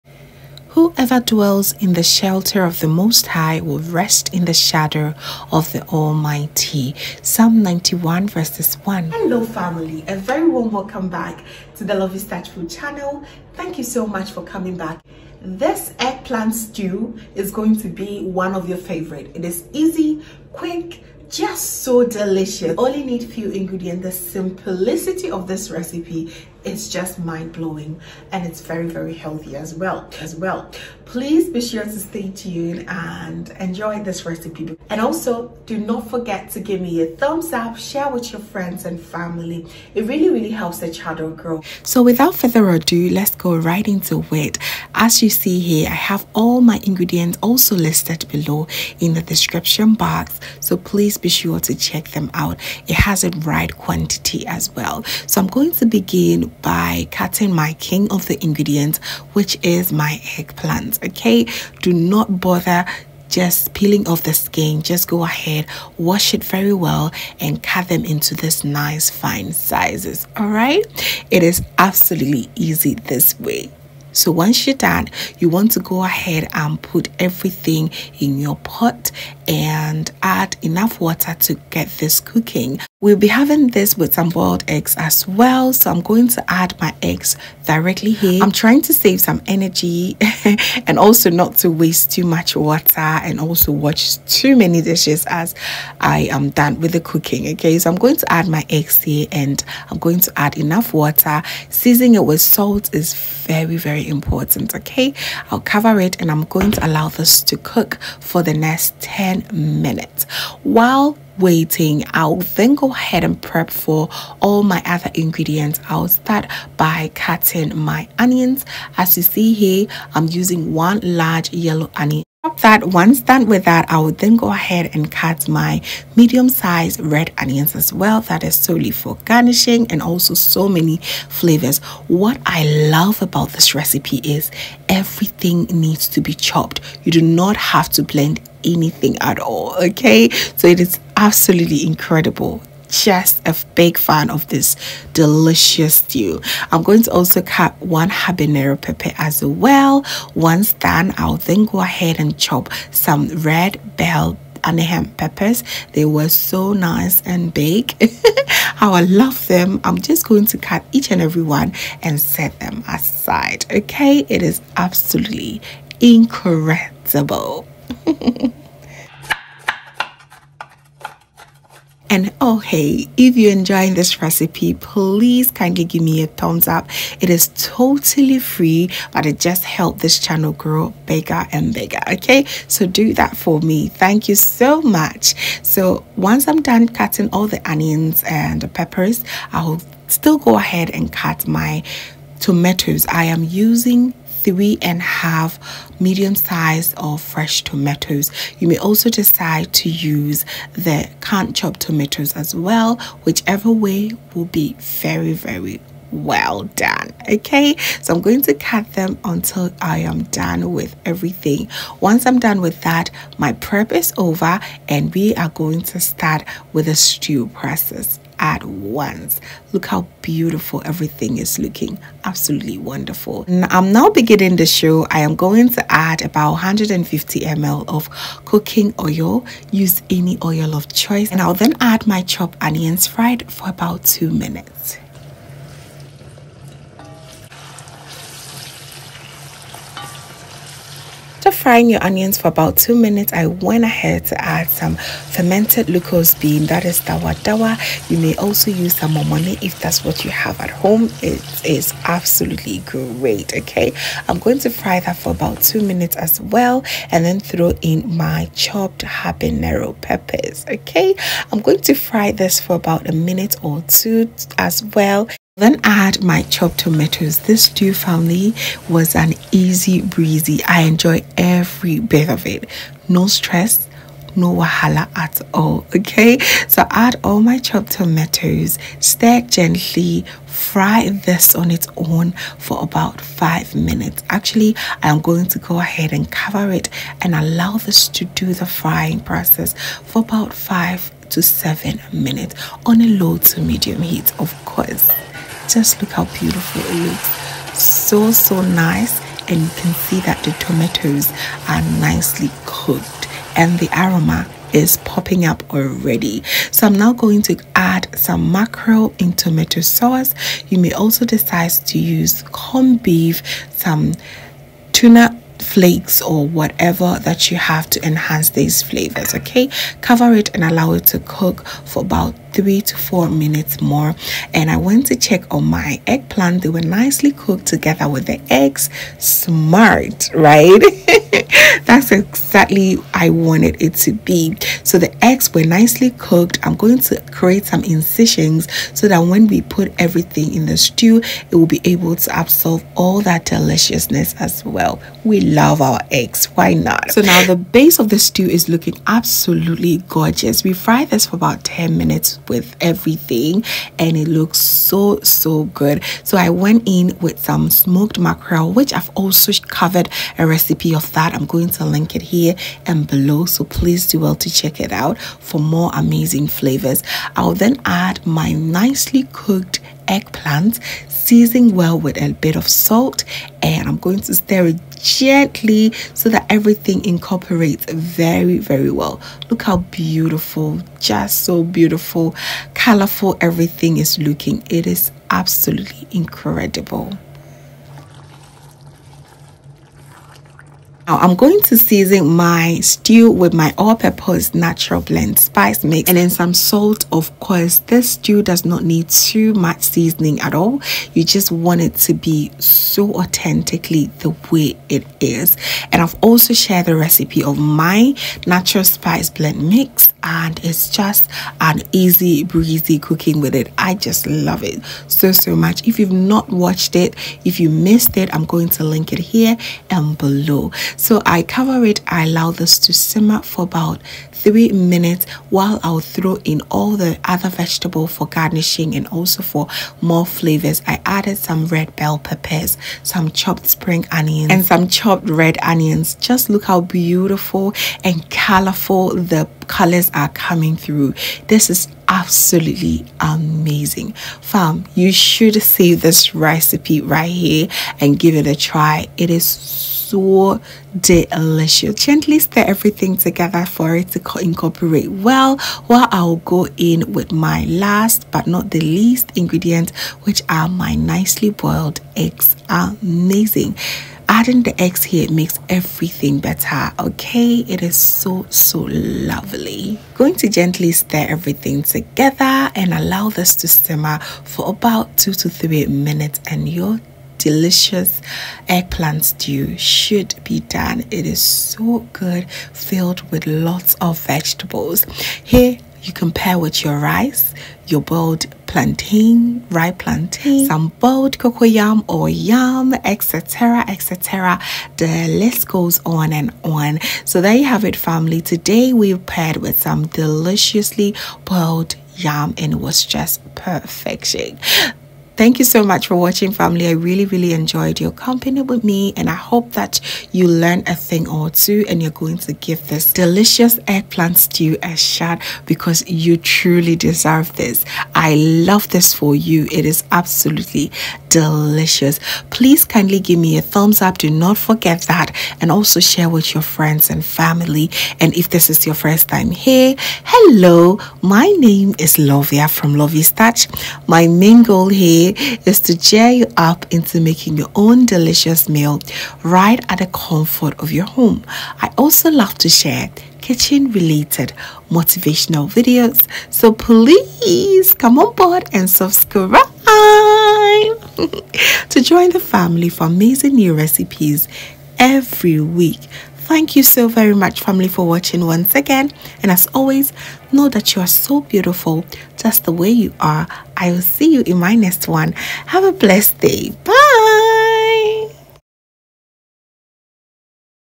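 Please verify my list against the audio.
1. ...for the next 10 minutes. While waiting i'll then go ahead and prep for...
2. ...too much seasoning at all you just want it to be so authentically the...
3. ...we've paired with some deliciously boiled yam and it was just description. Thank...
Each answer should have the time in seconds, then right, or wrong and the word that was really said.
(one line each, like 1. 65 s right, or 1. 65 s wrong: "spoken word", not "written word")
1. 108 s right
2. 399 s right
3. 498 s wrong: "perfection", not "description".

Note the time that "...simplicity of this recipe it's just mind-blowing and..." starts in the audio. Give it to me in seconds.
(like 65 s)
24 s.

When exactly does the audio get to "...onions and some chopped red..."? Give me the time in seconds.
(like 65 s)
434 s.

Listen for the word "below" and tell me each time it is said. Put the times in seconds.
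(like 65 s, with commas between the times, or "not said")
48 s, 363 s, 420 s.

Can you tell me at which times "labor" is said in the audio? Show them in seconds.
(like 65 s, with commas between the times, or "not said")
not said.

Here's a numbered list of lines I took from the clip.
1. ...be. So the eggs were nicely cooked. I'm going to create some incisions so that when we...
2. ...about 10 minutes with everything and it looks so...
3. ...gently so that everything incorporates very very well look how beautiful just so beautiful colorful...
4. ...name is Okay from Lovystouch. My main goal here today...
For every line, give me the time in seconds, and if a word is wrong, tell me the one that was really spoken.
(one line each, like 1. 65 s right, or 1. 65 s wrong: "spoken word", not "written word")
1. 334 s right
2. 351 s right
3. 375 s right
4. 531 s wrong: "Lovia", not "Okay".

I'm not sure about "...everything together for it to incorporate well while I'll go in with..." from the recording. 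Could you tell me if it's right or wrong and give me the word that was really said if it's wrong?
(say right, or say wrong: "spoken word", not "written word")
right.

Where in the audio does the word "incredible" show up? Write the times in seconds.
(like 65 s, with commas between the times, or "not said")
141 s, 166 s, 386 s.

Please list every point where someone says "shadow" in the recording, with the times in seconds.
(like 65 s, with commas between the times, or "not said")
4 s.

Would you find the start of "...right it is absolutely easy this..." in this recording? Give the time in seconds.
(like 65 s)
70 s.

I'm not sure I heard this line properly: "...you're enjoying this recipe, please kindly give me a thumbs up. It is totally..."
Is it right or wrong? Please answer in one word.
right.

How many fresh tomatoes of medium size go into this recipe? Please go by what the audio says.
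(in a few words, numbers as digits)
3.5.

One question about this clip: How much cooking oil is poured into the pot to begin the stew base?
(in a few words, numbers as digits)
150 ml.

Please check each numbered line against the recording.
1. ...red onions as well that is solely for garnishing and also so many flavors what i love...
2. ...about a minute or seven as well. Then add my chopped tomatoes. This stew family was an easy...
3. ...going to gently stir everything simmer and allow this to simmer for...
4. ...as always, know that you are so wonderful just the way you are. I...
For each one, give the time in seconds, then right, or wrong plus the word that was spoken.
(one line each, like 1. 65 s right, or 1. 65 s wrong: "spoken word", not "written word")
1. 126 s right
2. 262 s wrong: "two", not "seven"
3. 470 s wrong: "together", not "simmer"
4. 559 s wrong: "beautiful", not "wonderful".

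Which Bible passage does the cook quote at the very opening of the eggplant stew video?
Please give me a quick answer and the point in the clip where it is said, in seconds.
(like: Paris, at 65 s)
Psalm 91:1, at 7 s.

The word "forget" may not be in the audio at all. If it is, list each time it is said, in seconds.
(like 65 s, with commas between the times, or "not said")
36 s, 524 s.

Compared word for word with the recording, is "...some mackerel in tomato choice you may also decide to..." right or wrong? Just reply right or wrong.
wrong.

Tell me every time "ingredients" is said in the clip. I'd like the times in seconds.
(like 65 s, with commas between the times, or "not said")
23 s, 46 s, 58 s, 115 s, 459 s.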